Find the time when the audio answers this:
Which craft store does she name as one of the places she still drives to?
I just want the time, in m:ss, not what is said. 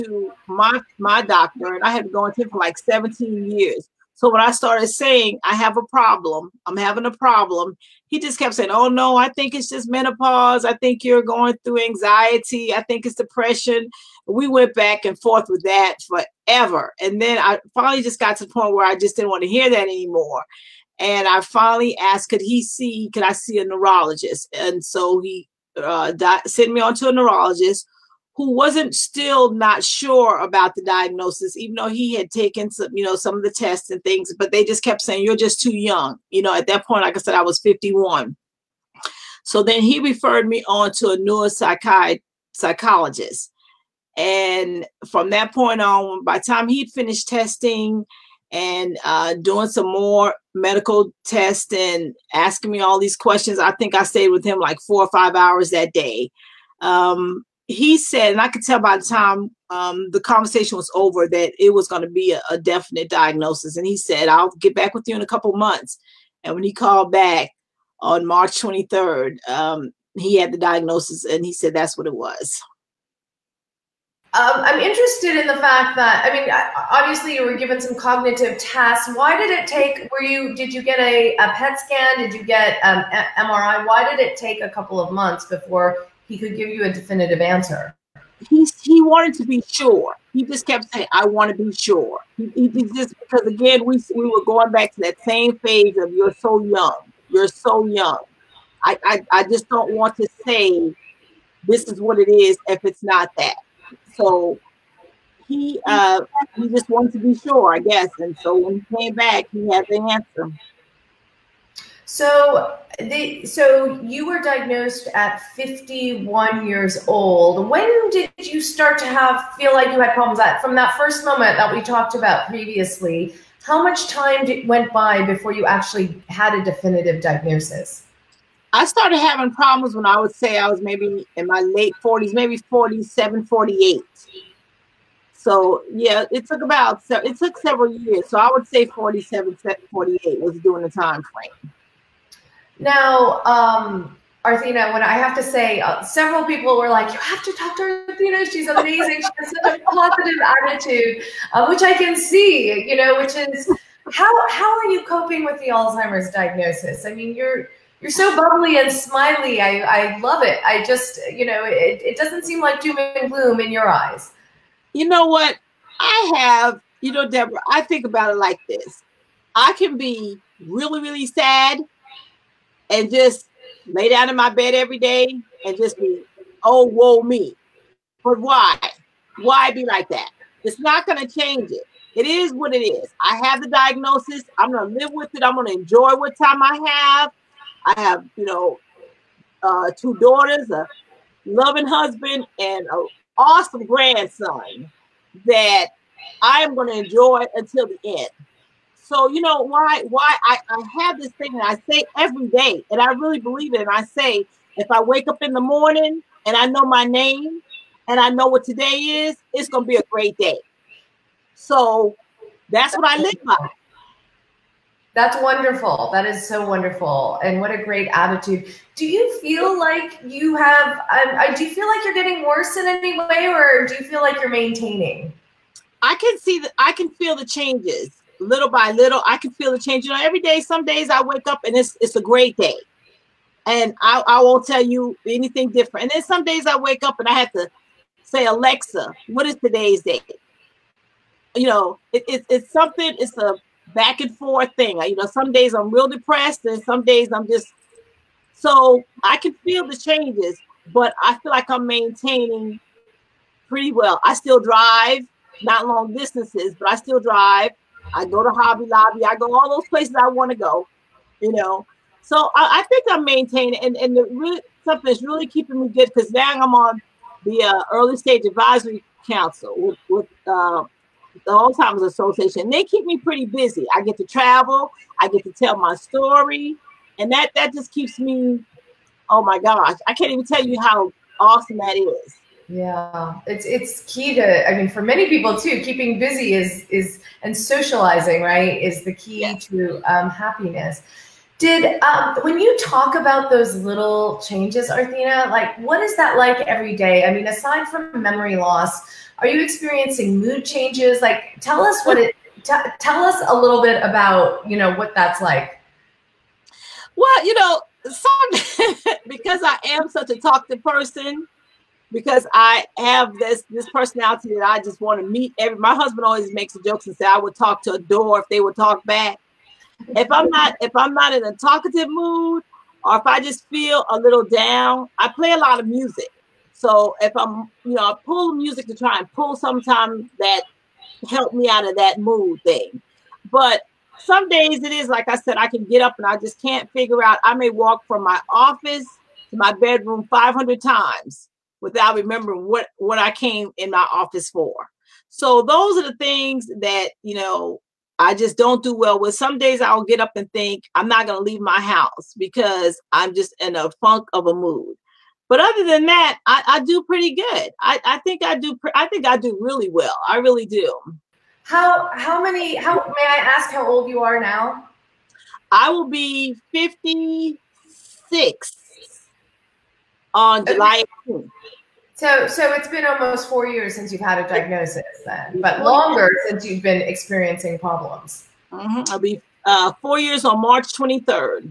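4:18.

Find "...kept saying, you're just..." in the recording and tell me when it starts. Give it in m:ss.
0:34.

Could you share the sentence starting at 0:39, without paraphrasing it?
So then he referred me on to a neuropsychiatrist.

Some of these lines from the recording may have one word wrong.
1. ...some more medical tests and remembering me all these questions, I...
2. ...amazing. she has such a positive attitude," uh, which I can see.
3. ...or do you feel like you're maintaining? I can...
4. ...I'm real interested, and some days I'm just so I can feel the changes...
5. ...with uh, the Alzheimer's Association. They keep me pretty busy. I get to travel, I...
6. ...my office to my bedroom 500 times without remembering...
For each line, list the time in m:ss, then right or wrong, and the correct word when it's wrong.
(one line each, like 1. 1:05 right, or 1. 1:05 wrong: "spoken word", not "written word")
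1. 0:49 wrong: "asking", not "remembering"
2. 2:28 right
3. 3:43 right
4. 4:05 wrong: "depressed", not "interested"
5. 4:30 right
6. 5:38 right.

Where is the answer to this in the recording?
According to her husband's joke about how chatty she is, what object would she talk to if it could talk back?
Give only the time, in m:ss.
5:17.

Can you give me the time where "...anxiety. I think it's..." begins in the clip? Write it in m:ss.
0:11.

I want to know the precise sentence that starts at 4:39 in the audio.
Oh my gosh, I can't even tell you how awesome that is.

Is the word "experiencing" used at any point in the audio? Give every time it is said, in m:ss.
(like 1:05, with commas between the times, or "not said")
4:59, 6:16.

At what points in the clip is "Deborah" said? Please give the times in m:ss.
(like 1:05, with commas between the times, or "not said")
2:47.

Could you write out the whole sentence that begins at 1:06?
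And when he called back on March 23rd, um, he had the diagnosis and he said that's what it was.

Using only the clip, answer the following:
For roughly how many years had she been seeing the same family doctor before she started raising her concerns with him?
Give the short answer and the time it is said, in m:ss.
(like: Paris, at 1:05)
17 years, at 0:02.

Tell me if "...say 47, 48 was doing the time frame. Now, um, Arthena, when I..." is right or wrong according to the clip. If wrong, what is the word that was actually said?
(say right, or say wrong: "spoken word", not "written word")
right.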